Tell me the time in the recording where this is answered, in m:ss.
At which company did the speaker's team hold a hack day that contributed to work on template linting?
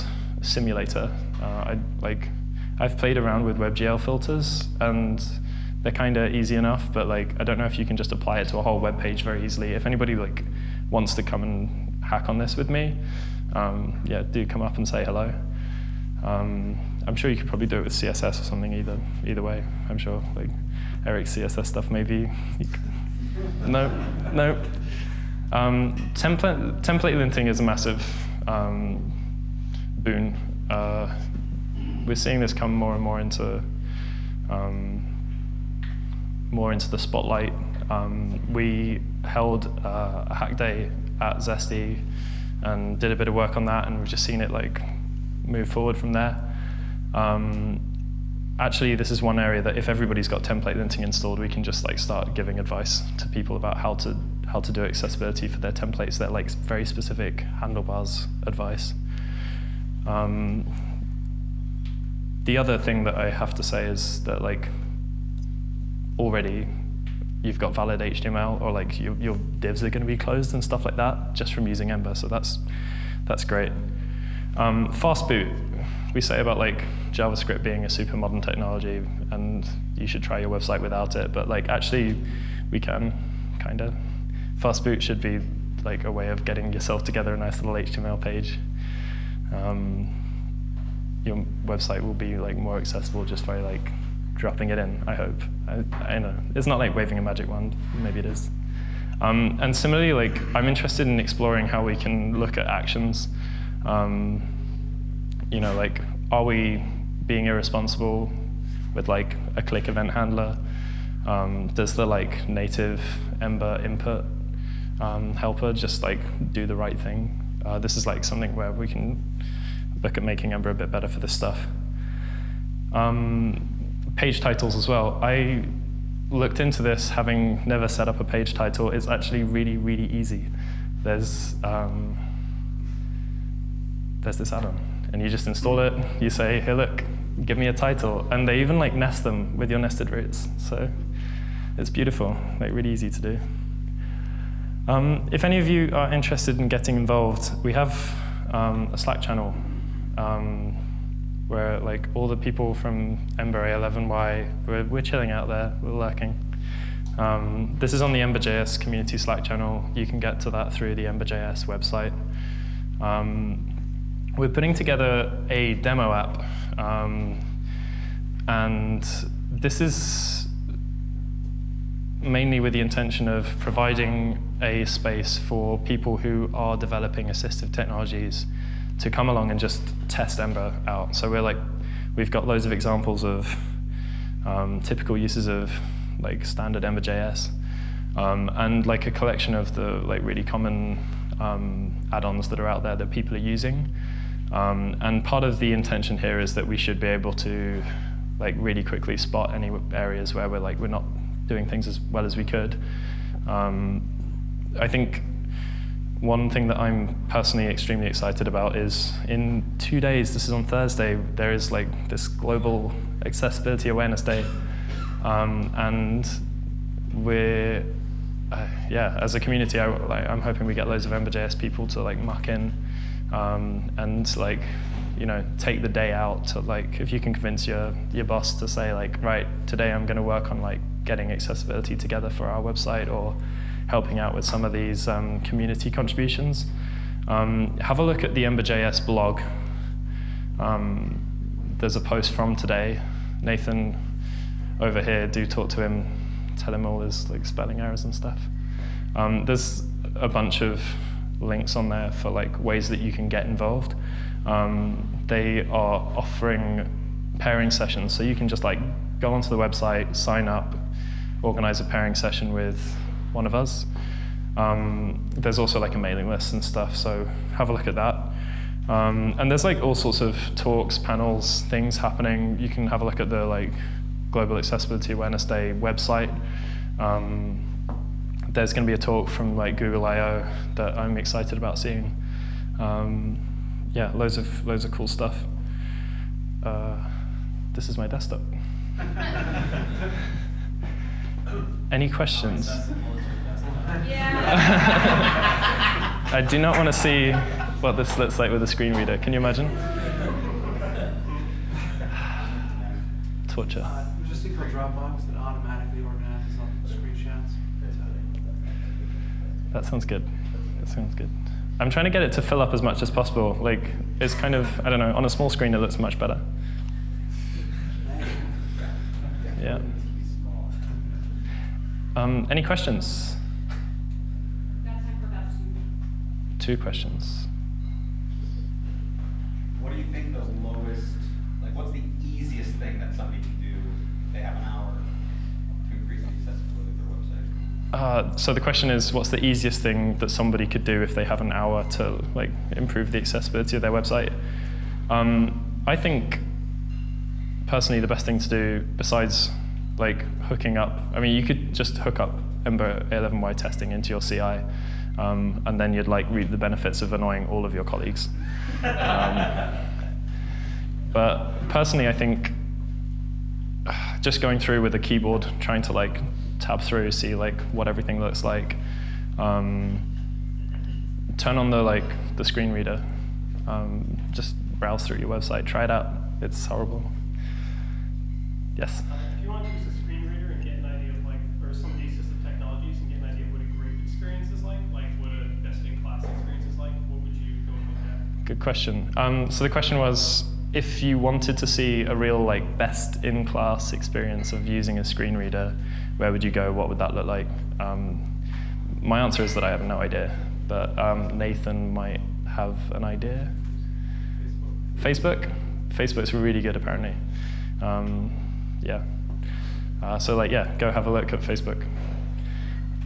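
0:41.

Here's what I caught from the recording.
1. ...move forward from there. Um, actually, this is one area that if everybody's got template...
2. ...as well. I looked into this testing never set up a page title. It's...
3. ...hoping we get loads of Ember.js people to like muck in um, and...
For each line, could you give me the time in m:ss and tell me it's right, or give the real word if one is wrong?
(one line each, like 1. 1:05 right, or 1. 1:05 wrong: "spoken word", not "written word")
1. 0:45 right
2. 2:04 wrong: "having", not "testing"
3. 3:40 right.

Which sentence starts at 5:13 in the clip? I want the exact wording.
Like, it's kind of, I don't know, on a small screen it looks much better.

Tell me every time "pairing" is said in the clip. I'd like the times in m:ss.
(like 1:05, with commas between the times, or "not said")
4:17, 4:21.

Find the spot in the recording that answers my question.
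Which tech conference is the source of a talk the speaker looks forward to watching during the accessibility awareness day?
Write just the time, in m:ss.
4:39.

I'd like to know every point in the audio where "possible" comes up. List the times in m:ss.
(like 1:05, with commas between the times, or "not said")
5:13.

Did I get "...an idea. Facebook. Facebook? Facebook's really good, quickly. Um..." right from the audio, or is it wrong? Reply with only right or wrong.
wrong.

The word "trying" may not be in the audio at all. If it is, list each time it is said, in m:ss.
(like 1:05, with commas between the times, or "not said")
5:11, 6:05.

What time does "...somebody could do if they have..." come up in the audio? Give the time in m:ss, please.
5:40.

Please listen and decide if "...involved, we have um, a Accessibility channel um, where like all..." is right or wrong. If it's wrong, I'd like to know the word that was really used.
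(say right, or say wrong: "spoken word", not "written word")
wrong: "Slack", not "Accessibility".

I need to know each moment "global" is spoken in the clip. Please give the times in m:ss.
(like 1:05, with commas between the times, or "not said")
3:32, 4:34.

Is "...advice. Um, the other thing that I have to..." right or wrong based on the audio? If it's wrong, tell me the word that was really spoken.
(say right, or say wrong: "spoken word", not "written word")
right.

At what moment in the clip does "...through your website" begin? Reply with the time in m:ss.
6:15.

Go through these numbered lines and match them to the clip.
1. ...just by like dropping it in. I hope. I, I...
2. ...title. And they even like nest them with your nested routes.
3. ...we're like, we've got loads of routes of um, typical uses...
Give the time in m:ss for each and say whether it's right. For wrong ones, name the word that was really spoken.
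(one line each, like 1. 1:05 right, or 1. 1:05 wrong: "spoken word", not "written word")
1. 1:33 right
2. 2:17 right
3. 3:01 wrong: "examples", not "routes".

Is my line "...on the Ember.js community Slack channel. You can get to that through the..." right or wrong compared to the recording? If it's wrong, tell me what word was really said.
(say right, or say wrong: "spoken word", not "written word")
right.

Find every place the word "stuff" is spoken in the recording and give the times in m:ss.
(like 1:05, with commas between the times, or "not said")
0:21, 1:10, 2:01, 4:08, 4:26, 4:45.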